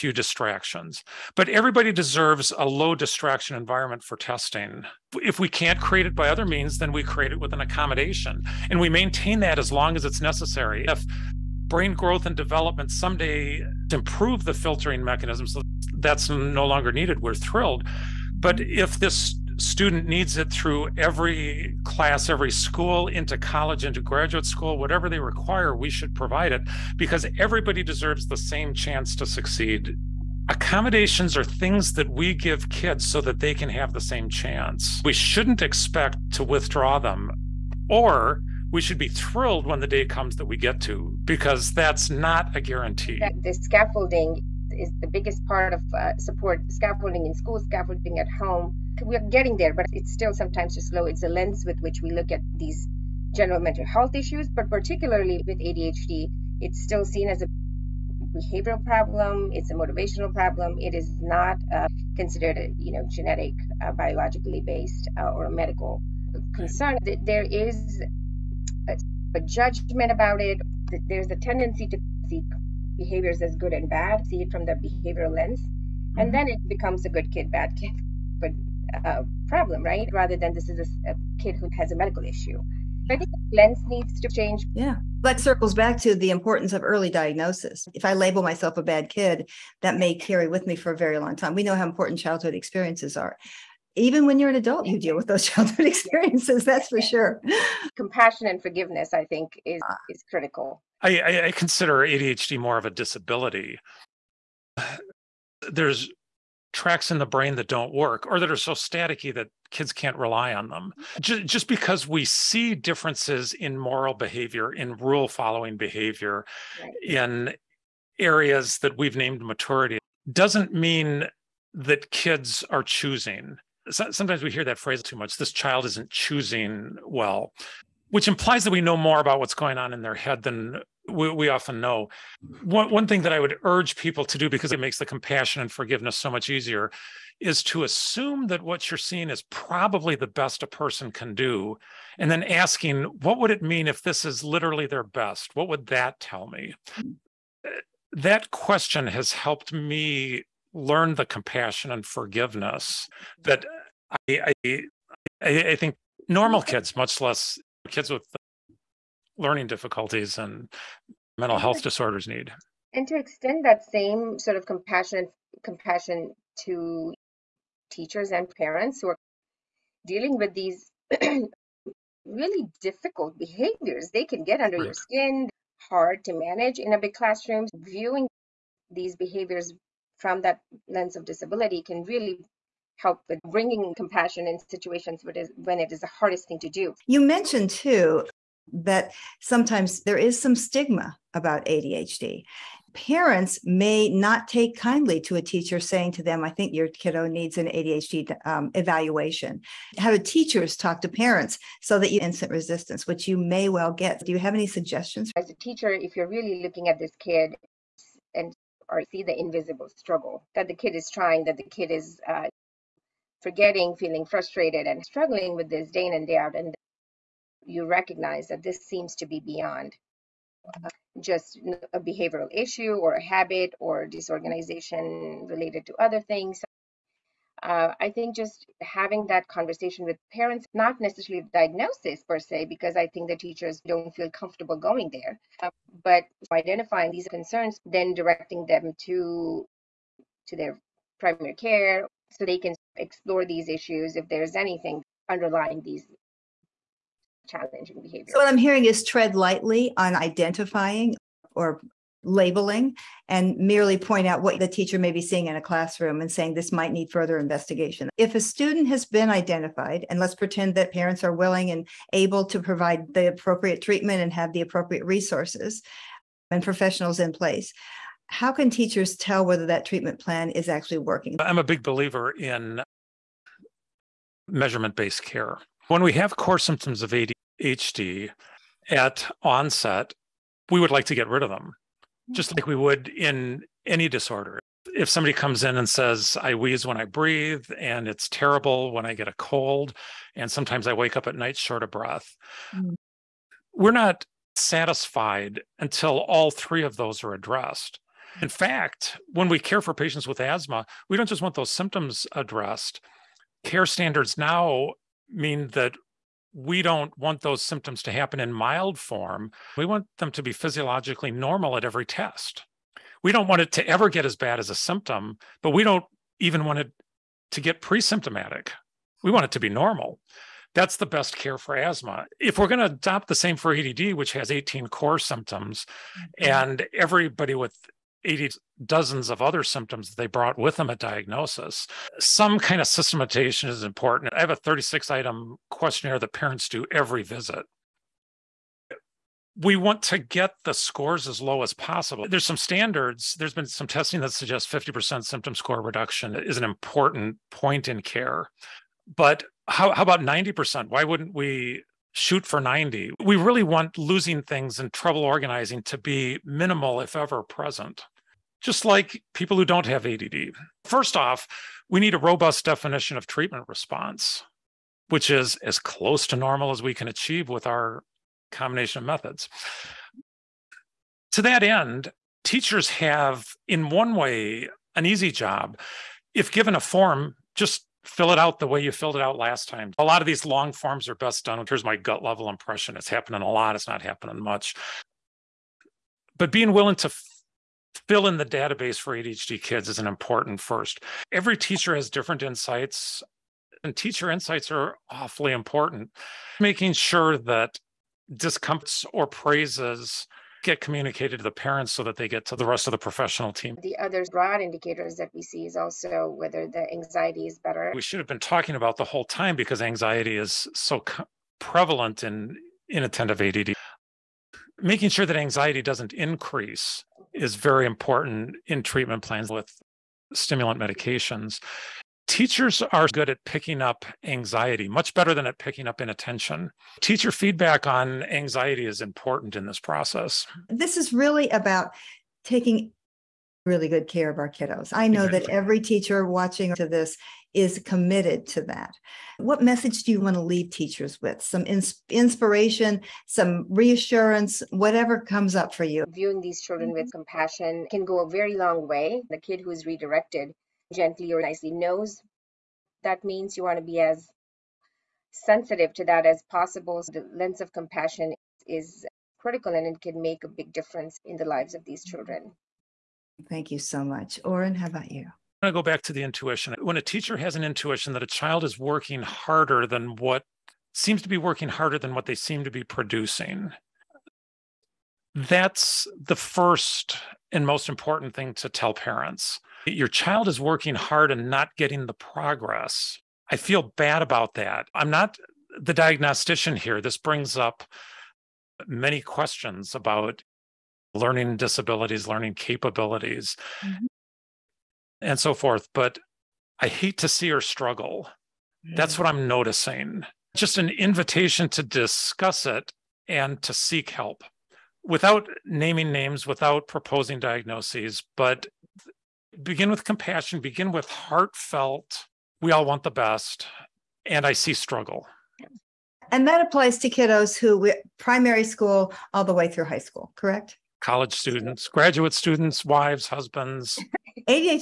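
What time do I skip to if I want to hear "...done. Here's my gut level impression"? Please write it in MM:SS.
06:21.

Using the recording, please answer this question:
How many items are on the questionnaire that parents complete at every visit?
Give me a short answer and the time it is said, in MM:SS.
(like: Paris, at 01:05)
36, at 05:34.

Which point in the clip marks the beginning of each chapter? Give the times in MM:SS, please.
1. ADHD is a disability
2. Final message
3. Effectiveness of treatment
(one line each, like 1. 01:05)
1. 01:24
2. 07:19
3. 04:31.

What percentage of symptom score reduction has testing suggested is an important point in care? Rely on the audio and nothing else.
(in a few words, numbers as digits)
50%.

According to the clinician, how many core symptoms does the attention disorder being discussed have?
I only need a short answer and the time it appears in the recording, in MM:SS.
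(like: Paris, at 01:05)
18, at 05:24.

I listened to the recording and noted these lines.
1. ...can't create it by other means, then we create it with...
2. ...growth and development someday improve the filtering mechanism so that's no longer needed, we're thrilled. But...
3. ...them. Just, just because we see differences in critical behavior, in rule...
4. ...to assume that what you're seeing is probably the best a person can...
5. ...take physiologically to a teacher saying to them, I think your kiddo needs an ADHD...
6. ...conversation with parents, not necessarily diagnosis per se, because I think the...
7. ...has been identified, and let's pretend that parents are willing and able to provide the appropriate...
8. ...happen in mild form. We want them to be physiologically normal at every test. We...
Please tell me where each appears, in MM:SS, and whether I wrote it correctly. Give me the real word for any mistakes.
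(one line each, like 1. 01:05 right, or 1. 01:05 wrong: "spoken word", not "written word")
1. 00:05 right
2. 00:11 right
3. 01:50 wrong: "moral", not "critical"
4. 02:17 right
5. 03:14 wrong: "kindly", not "physiologically"
6. 03:49 right
7. 04:18 right
8. 05:08 right.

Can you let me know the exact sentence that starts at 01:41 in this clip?
I, I consider ADHD more of a disability.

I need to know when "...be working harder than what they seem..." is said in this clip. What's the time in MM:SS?
07:51.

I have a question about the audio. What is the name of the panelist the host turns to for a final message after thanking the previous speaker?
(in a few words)
Oren.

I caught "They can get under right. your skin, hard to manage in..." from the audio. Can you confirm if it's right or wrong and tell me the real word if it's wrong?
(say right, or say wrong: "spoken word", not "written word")
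right.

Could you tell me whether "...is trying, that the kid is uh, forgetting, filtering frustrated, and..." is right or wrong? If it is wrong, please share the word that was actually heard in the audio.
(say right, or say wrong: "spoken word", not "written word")
wrong: "feeling", not "filtering".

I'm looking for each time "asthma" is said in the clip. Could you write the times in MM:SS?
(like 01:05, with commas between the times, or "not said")
05:00, 05:21.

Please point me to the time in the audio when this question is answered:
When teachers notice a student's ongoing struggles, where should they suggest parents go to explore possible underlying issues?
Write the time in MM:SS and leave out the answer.
04:01.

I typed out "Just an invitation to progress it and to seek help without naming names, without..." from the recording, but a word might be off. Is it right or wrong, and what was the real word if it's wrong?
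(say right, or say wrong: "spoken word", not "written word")
wrong: "discuss", not "progress".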